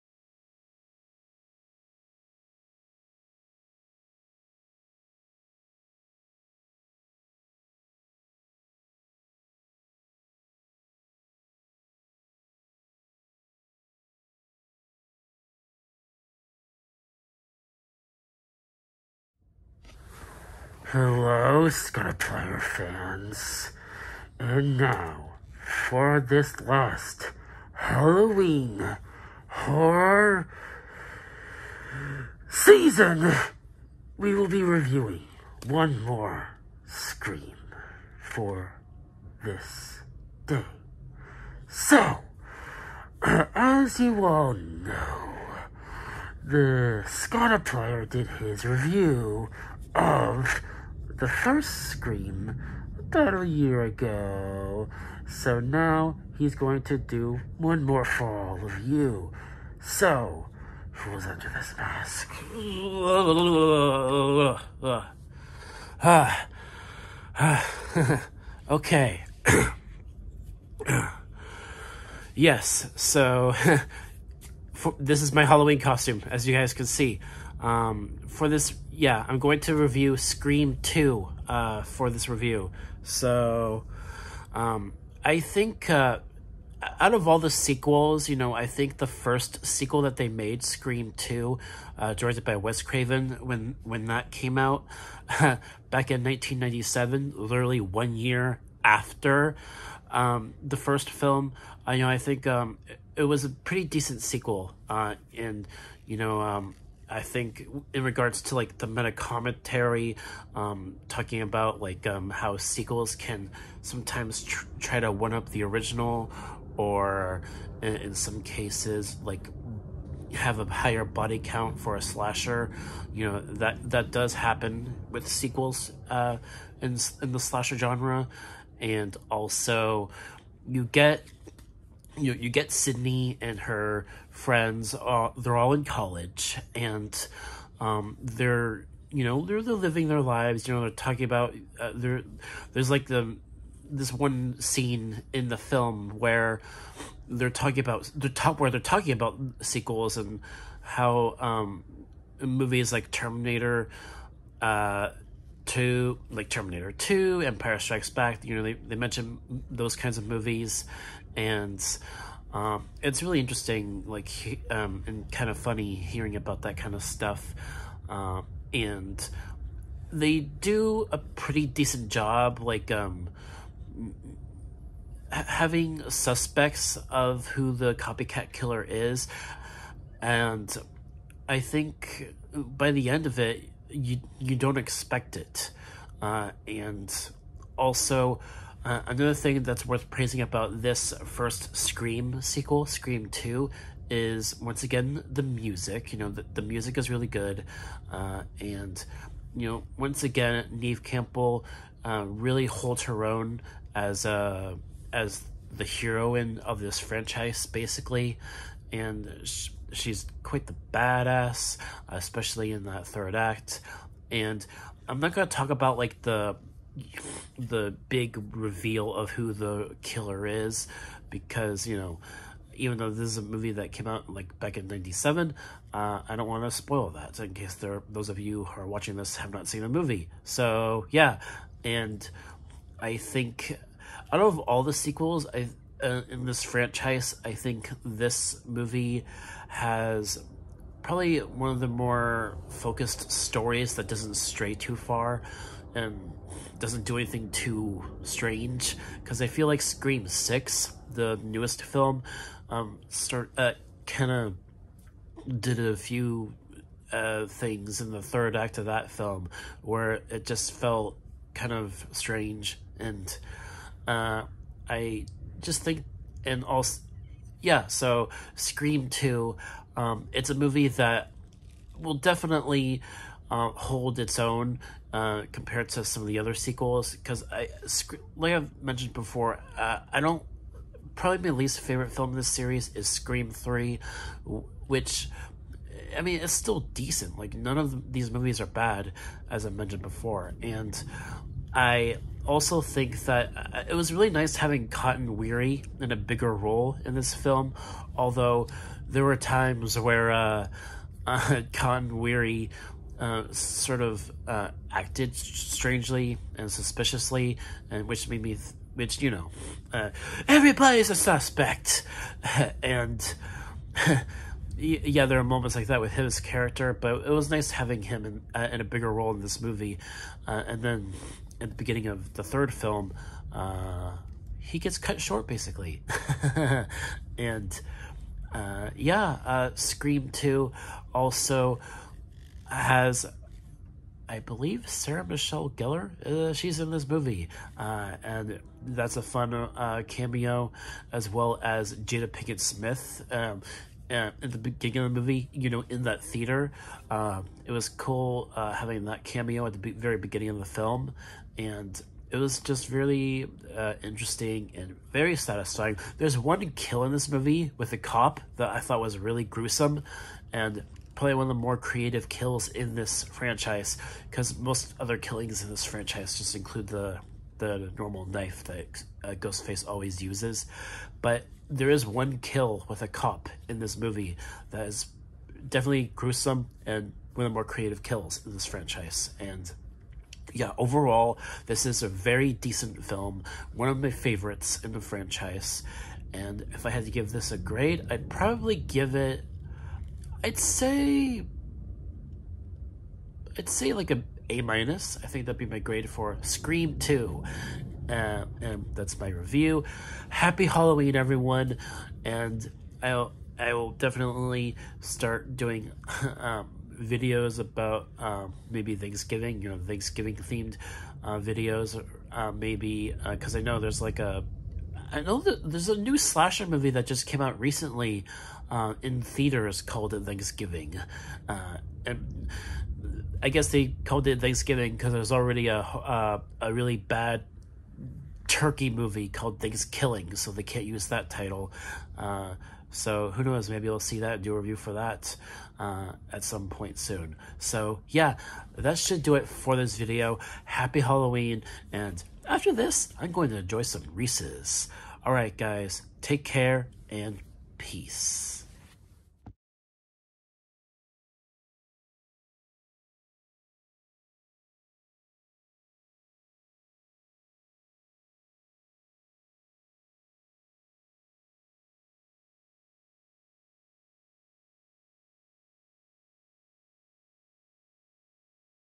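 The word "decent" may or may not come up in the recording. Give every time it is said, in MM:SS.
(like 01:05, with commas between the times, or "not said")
01:43, 02:51, 04:46, 06:22.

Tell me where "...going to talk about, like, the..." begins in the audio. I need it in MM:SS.
03:35.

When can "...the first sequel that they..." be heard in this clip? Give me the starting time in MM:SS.
01:28.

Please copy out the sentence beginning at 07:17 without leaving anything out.
So yeah, that should do it for this video.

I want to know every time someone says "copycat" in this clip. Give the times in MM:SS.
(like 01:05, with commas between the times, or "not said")
02:57.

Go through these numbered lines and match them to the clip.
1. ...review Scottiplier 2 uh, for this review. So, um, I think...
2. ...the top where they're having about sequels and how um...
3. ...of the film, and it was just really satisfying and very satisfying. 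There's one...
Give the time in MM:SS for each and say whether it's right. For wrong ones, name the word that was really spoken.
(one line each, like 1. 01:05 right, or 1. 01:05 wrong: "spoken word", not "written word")
1. 01:19 wrong: "Scream", not "Scottiplier"
2. 02:28 wrong: "talking", not "having"
3. 05:50 wrong: "interesting", not "satisfying".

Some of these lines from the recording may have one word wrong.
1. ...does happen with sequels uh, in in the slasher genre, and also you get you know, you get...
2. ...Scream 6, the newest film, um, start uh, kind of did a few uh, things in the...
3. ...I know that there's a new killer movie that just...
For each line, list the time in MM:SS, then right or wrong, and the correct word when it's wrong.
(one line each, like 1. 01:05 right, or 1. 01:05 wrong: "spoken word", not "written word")
1. 02:04 right
2. 04:09 right
3. 06:55 wrong: "slasher", not "killer".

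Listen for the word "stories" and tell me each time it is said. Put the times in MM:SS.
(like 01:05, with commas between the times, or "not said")
04:03.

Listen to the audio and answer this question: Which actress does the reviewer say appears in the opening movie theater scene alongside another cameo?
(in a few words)
Jada Pinkett Smith.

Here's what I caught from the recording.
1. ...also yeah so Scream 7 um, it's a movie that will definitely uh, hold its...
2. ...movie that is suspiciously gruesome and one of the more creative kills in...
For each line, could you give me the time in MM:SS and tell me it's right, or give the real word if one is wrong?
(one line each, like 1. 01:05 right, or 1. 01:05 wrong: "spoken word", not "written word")
1. 04:26 wrong: "2", not "7"
2. 06:13 wrong: "definitely", not "suspiciously".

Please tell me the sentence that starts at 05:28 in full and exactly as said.
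Uh, yeah, Scream 2 also has, I believe Sarah Michelle Gellar.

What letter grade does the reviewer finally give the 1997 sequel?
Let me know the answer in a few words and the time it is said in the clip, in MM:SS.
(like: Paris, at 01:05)
A minus, at 06:34.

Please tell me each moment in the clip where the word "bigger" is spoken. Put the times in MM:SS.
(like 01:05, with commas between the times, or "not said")
04:56, 05:18.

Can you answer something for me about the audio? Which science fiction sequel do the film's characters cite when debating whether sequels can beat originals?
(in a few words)
Empire Strikes Back.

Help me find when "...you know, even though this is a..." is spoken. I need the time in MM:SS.
03:41.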